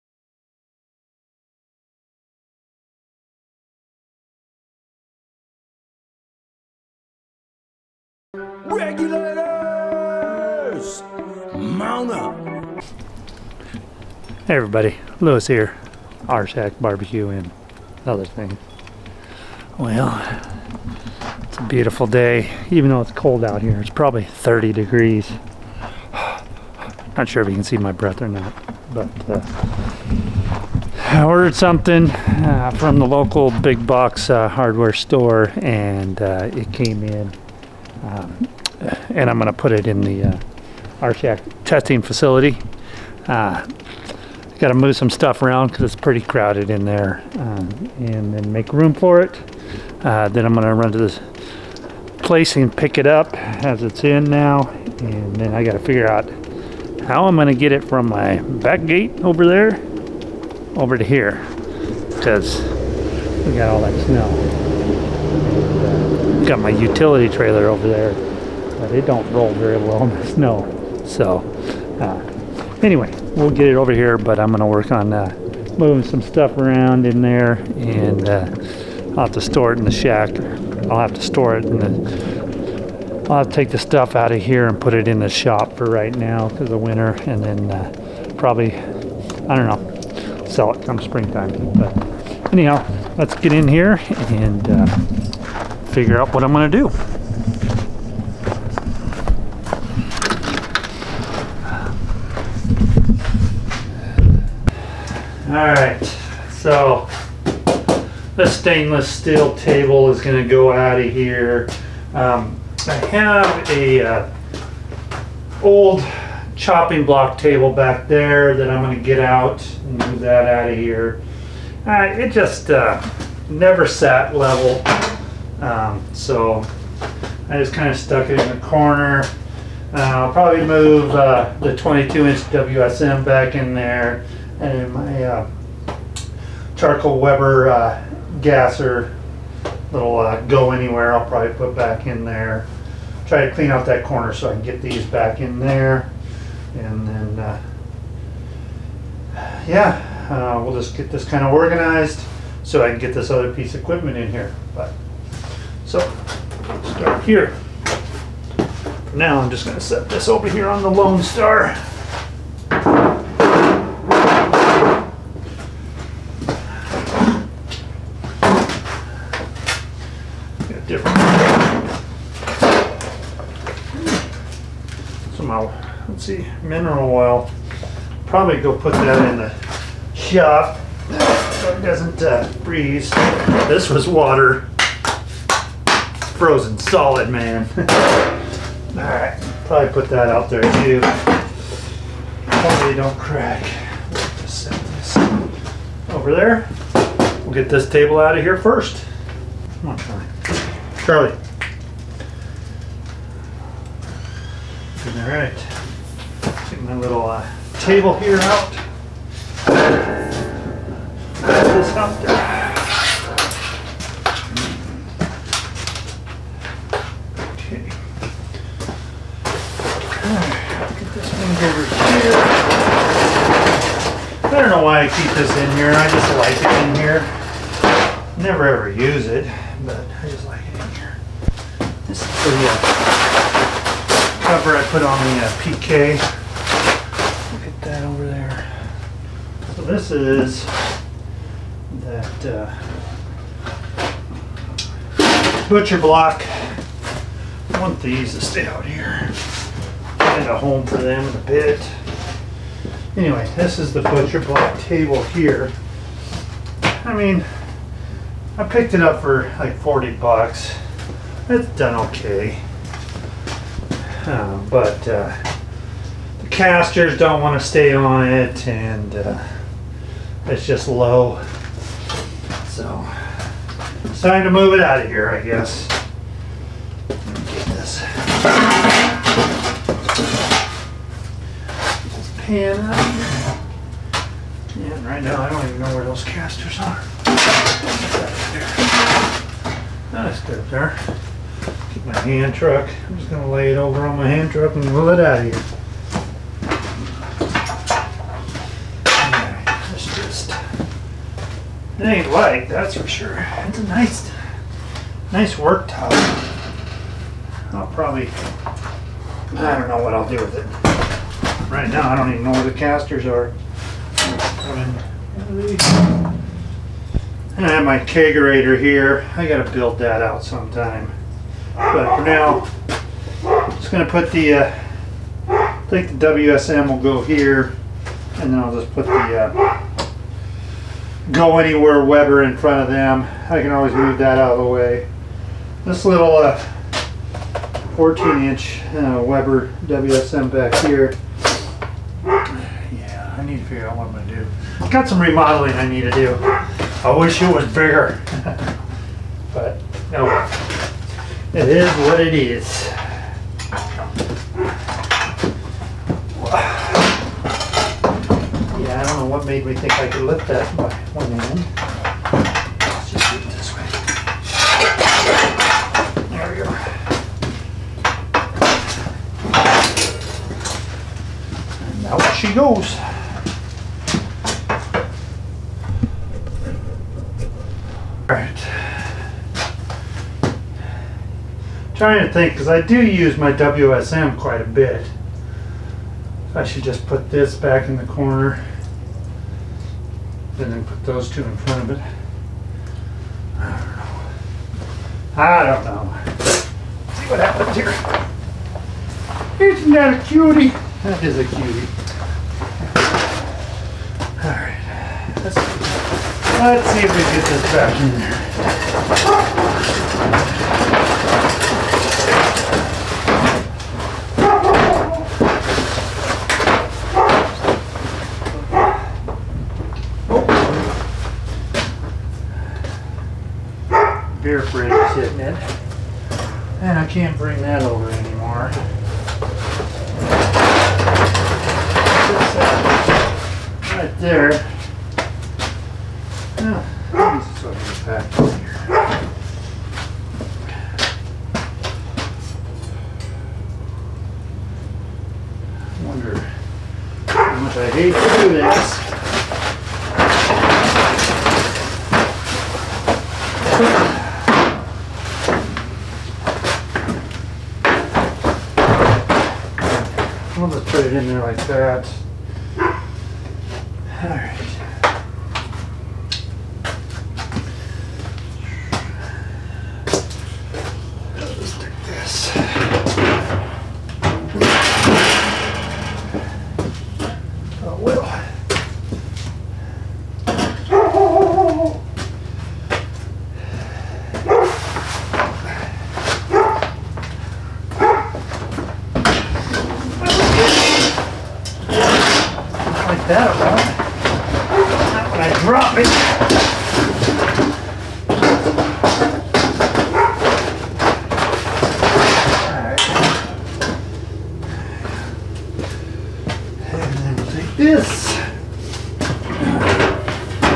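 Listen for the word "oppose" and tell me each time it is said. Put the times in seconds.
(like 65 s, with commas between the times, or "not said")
not said.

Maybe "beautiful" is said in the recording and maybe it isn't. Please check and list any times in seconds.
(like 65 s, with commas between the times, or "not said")
21 s.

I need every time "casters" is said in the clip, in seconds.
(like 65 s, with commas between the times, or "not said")
266 s, 286 s, 312 s.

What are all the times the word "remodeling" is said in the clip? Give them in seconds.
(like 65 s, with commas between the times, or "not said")
345 s.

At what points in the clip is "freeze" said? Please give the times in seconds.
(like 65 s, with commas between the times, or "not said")
182 s.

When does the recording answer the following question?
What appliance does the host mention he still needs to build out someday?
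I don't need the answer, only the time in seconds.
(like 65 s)
317 s.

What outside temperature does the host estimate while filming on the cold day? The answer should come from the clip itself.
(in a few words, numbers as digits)
30 degrees.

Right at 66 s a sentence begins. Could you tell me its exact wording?
Got my utility trailer over there but it don't roll very well in the snow.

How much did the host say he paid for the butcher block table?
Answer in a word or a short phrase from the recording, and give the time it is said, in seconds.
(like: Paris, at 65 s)
$40, at 259 s.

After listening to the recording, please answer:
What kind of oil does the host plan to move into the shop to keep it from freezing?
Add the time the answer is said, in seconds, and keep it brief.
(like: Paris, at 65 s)
Mineral oil, at 176 s.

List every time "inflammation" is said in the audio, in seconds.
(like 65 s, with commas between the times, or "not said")
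not said.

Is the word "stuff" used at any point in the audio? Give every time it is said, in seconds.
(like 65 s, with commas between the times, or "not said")
45 s, 76 s, 83 s.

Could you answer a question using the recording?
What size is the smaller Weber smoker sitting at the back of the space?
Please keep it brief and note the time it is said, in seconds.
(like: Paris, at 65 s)
14 inch, at 337 s.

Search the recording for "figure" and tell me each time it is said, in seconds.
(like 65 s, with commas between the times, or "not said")
55 s, 95 s, 343 s.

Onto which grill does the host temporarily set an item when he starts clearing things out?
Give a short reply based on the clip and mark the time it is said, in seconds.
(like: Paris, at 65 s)
Lone Star, at 160 s.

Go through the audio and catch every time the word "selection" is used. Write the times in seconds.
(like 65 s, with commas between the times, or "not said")
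not said.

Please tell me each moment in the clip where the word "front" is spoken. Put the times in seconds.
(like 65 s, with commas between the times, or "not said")
332 s, 391 s.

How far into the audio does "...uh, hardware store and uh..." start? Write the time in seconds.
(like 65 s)
34 s.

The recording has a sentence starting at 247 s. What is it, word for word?
I want these to stay out here.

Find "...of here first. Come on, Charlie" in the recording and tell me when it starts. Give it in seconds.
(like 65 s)
198 s.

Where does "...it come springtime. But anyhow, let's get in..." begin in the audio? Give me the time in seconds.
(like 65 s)
90 s.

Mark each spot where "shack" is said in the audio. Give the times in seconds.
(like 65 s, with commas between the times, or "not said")
16 s, 79 s.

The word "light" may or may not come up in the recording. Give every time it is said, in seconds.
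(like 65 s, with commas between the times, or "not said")
302 s.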